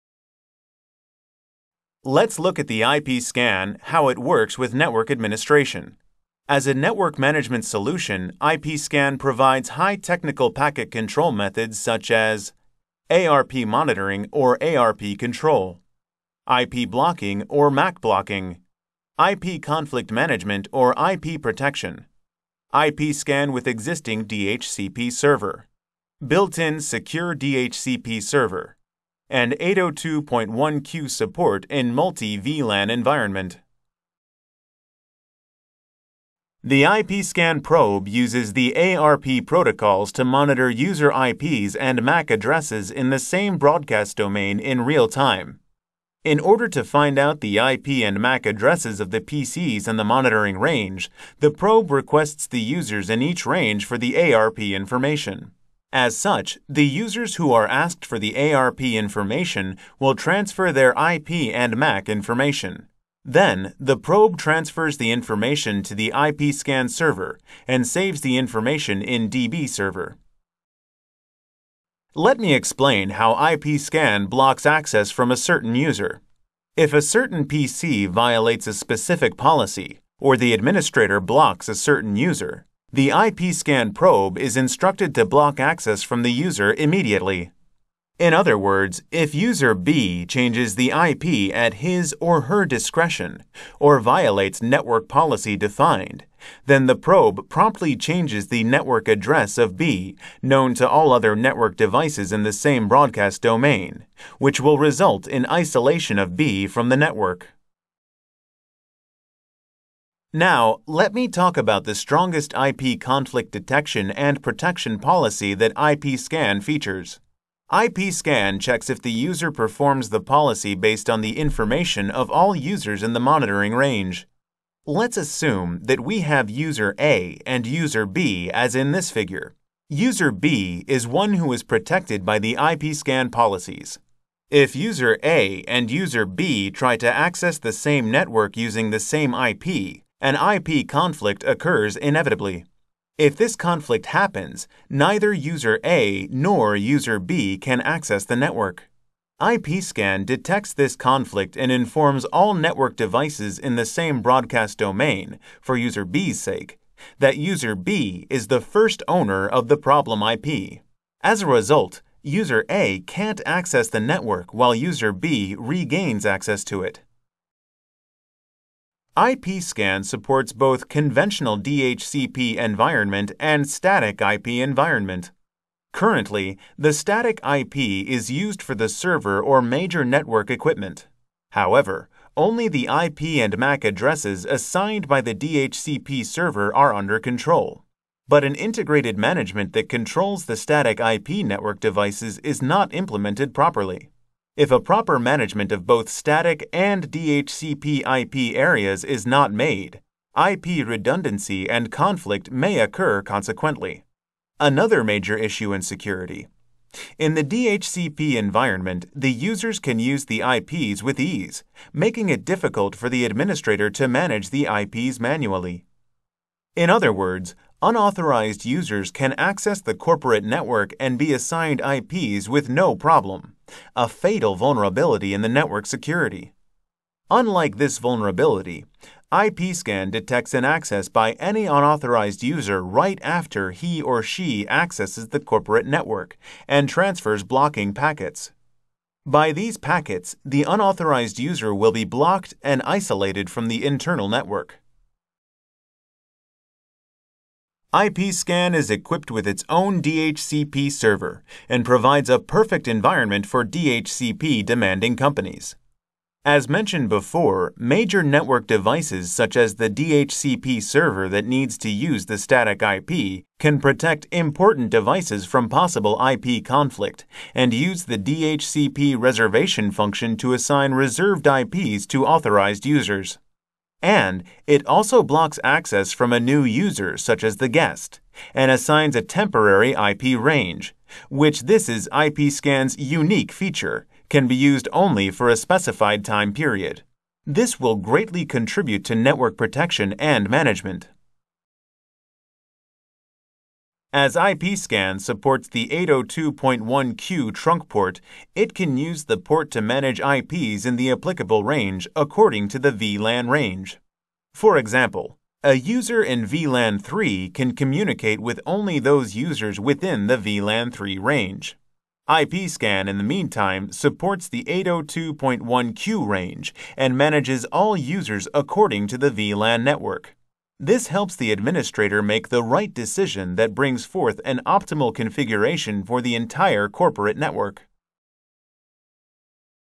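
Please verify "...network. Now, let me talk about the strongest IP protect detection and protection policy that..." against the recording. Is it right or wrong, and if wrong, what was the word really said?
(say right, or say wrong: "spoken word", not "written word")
wrong: "conflict", not "protect".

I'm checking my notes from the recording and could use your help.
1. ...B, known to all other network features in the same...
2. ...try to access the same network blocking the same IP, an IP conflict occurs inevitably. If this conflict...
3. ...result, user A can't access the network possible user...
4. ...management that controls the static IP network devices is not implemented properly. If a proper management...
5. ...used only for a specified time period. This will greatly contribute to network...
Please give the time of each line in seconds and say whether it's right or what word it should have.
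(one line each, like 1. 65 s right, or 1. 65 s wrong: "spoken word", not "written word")
1. 99 s wrong: "devices", not "features"
2. 136 s wrong: "using", not "blocking"
3. 161 s wrong: "while", not "possible"
4. 189 s right
5. 284 s right.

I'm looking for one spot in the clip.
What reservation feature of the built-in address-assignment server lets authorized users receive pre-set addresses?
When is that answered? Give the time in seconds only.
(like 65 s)
268 s.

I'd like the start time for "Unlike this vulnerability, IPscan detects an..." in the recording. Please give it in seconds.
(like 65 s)
227 s.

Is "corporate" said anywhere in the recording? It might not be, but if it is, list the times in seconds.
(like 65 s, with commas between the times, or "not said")
219 s, 235 s, 326 s.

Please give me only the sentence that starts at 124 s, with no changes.
Let's assume that we have user A and user B as in this figure.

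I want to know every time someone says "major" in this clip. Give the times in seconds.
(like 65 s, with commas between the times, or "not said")
179 s, 205 s, 257 s.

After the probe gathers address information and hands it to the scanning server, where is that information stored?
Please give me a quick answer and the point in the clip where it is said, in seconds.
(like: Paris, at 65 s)
DB server, at 69 s.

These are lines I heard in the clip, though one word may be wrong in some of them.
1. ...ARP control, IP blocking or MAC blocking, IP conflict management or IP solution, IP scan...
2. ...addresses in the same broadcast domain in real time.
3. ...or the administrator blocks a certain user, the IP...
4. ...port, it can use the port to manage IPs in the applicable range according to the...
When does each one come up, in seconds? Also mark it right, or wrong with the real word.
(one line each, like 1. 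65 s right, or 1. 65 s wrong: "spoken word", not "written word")
1. 14 s wrong: "protection", not "solution"
2. 42 s right
3. 80 s right
4. 297 s right.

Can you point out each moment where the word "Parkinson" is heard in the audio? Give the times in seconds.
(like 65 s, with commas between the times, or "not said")
not said.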